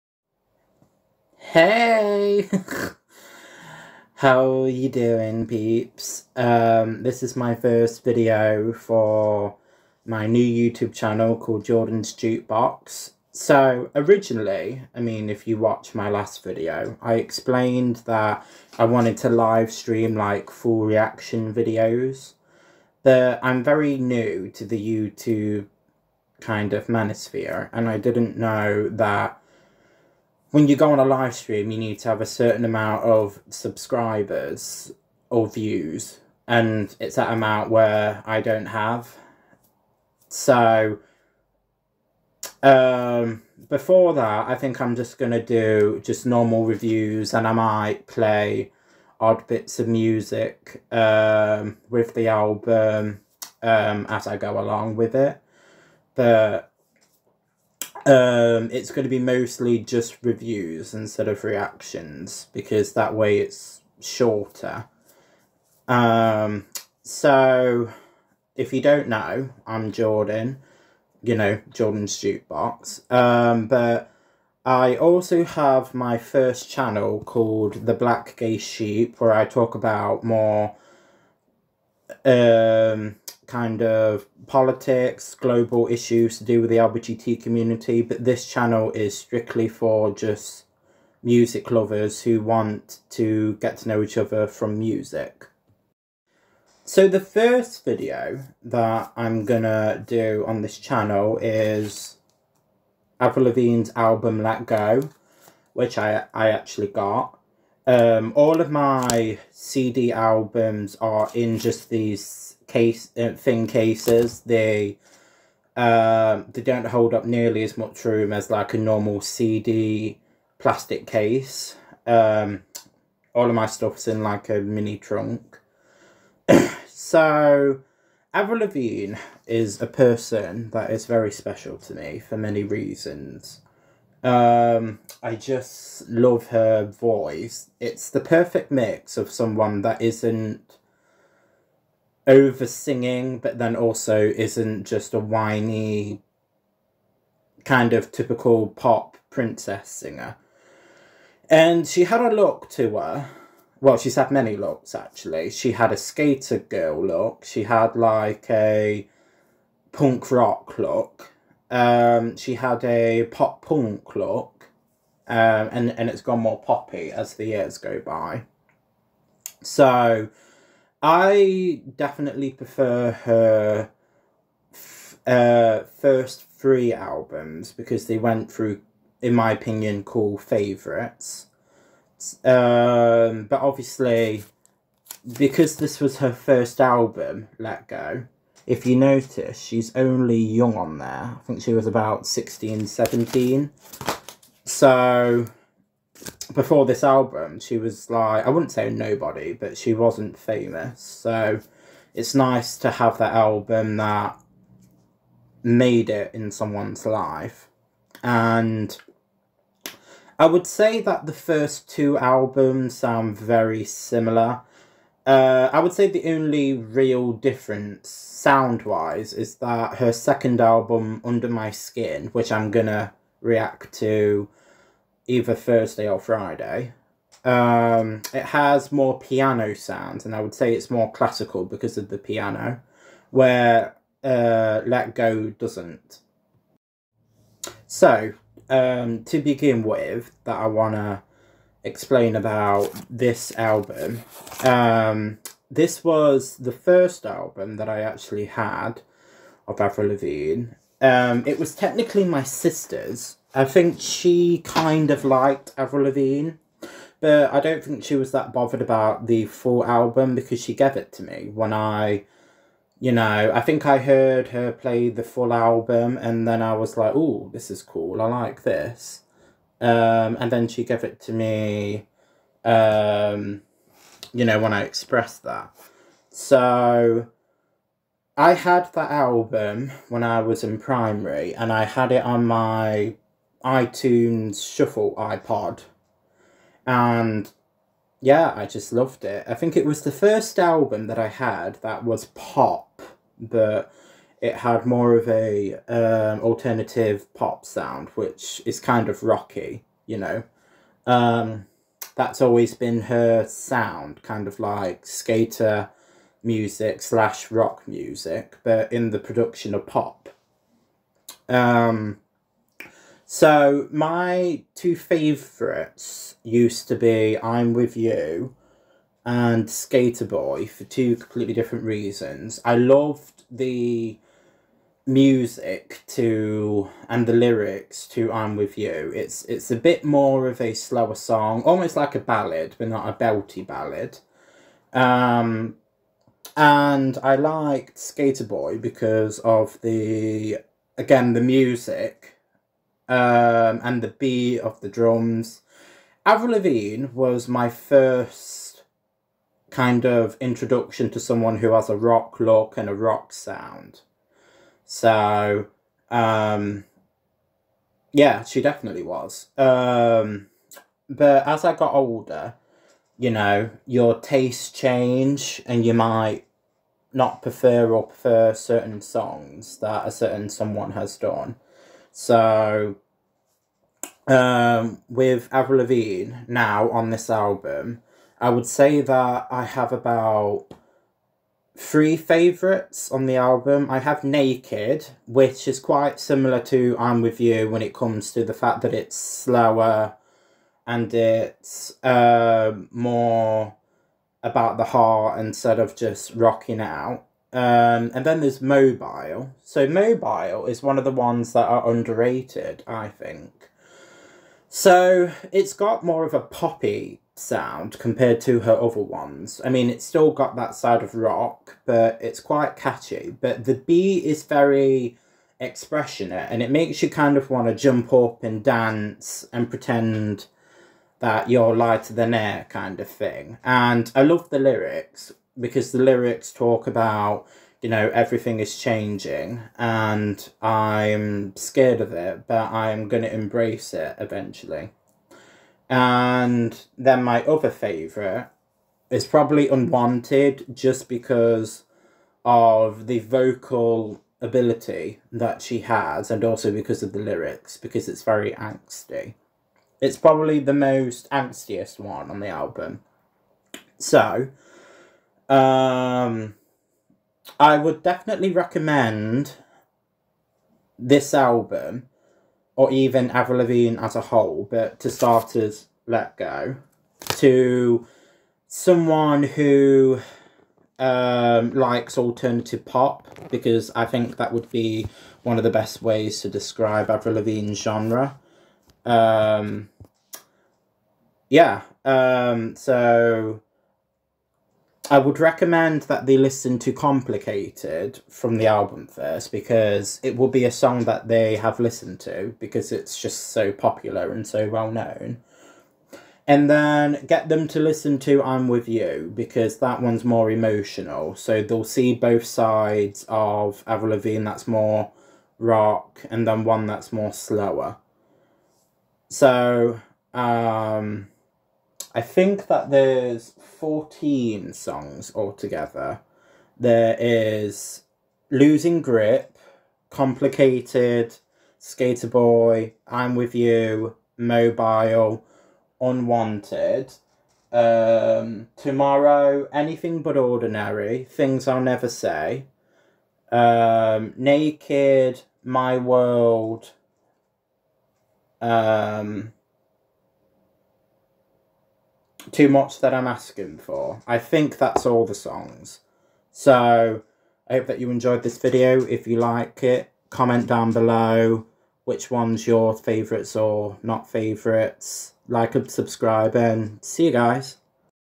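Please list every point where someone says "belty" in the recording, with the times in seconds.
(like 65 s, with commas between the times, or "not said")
333 s.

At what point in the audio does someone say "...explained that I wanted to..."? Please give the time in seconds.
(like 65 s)
17 s.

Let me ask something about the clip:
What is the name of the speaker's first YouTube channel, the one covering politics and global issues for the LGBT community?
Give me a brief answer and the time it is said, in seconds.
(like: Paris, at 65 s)
The Black Gay Sheep, at 77 s.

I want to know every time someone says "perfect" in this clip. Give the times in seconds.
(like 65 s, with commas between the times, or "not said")
138 s.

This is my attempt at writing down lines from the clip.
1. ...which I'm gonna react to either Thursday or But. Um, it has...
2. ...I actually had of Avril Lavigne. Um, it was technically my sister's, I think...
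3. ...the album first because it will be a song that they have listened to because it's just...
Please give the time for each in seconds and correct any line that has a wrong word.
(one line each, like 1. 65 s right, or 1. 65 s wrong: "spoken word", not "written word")
1. 222 s wrong: "Friday", not "But"
2. 247 s right
3. 488 s right.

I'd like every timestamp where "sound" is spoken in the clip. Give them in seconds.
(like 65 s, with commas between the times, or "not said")
212 s, 218 s, 229 s, 297 s, 303 s, 353 s, 407 s.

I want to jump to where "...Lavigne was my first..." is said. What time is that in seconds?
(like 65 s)
346 s.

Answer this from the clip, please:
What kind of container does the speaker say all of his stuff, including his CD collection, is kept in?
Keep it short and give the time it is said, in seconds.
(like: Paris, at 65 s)
A mini trunk, at 124 s.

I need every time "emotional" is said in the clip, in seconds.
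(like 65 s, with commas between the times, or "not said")
500 s.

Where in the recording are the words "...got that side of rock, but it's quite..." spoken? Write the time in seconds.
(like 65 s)
410 s.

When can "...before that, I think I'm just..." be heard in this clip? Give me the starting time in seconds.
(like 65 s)
43 s.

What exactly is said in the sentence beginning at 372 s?
So um, with Avril Lavigne now on this album, I would say that I have about three favourites on the album.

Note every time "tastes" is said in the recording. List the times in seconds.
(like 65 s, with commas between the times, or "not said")
364 s.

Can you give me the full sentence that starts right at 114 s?
They um, they don't hold up nearly as much room as like a normal CD plastic case.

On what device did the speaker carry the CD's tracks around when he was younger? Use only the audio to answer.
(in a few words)
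iTunes Shuffle iPod.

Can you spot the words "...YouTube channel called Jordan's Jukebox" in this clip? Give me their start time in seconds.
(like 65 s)
10 s.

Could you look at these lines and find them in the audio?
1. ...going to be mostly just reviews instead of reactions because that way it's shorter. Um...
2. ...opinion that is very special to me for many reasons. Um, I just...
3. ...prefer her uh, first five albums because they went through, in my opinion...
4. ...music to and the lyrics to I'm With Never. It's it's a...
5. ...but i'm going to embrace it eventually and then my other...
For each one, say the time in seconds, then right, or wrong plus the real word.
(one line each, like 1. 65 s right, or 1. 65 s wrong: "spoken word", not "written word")
1. 58 s right
2. 129 s wrong: "person", not "opinion"
3. 172 s wrong: "three", not "five"
4. 325 s wrong: "You", not "Never"
5. 432 s right.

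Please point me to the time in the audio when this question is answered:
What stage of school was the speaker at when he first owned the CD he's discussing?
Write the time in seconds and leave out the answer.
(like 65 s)
280 s.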